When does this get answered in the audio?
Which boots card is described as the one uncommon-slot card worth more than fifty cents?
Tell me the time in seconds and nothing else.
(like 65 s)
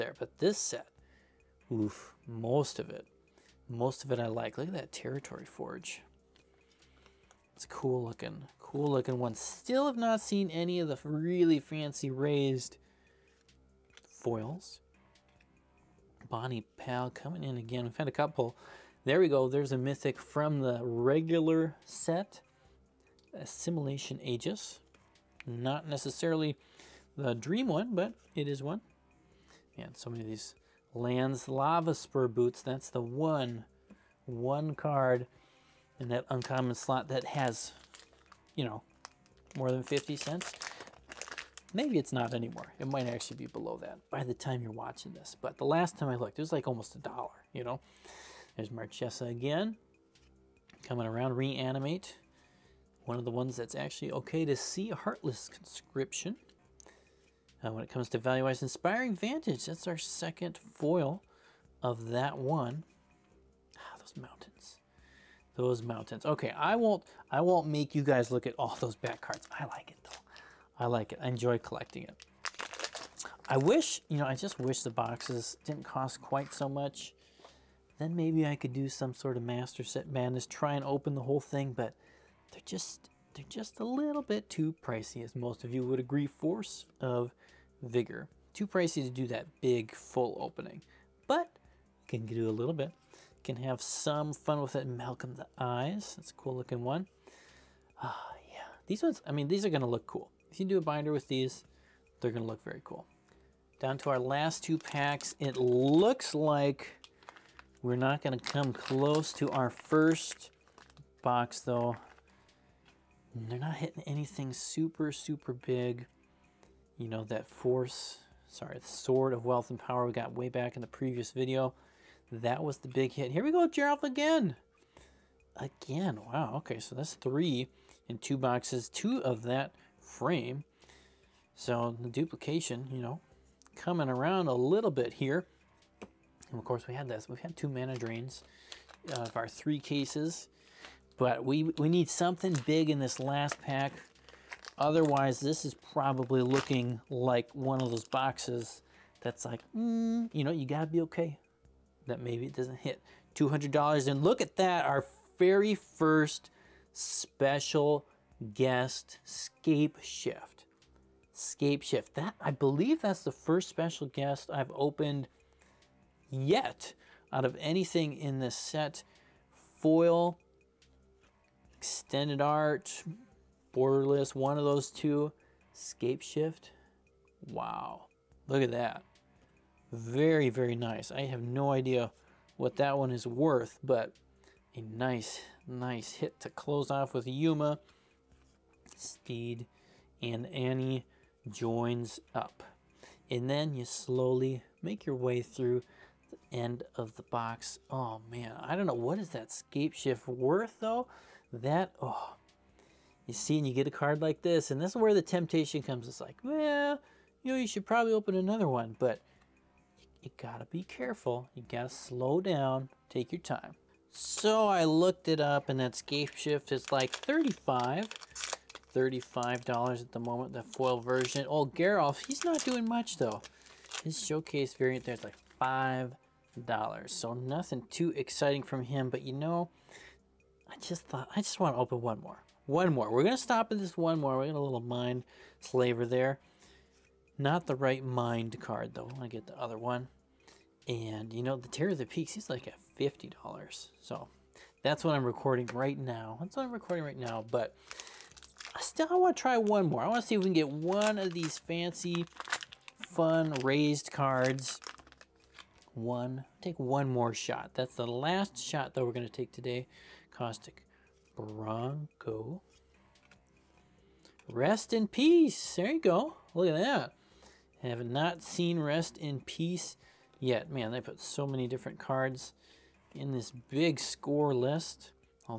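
31 s.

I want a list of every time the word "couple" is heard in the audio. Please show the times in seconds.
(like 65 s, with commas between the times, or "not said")
18 s.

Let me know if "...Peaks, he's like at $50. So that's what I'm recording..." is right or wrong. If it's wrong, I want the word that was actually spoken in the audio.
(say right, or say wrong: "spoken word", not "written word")
right.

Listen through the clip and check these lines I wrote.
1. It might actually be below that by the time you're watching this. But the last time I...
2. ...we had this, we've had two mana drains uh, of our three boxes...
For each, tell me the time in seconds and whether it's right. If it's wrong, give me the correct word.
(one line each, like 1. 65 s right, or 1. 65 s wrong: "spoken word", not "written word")
1. 42 s right
2. 136 s wrong: "cases", not "boxes".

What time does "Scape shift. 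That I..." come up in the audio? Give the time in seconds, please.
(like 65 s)
161 s.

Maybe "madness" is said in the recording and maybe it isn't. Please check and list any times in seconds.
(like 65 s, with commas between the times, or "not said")
80 s.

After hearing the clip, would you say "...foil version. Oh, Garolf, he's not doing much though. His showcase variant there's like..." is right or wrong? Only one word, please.
right.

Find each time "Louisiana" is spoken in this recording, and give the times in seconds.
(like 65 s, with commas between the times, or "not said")
not said.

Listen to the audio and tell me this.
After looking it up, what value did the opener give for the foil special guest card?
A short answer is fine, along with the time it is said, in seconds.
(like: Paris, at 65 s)
$35, at 217 s.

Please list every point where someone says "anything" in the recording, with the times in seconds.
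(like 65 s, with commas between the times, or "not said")
114 s, 167 s.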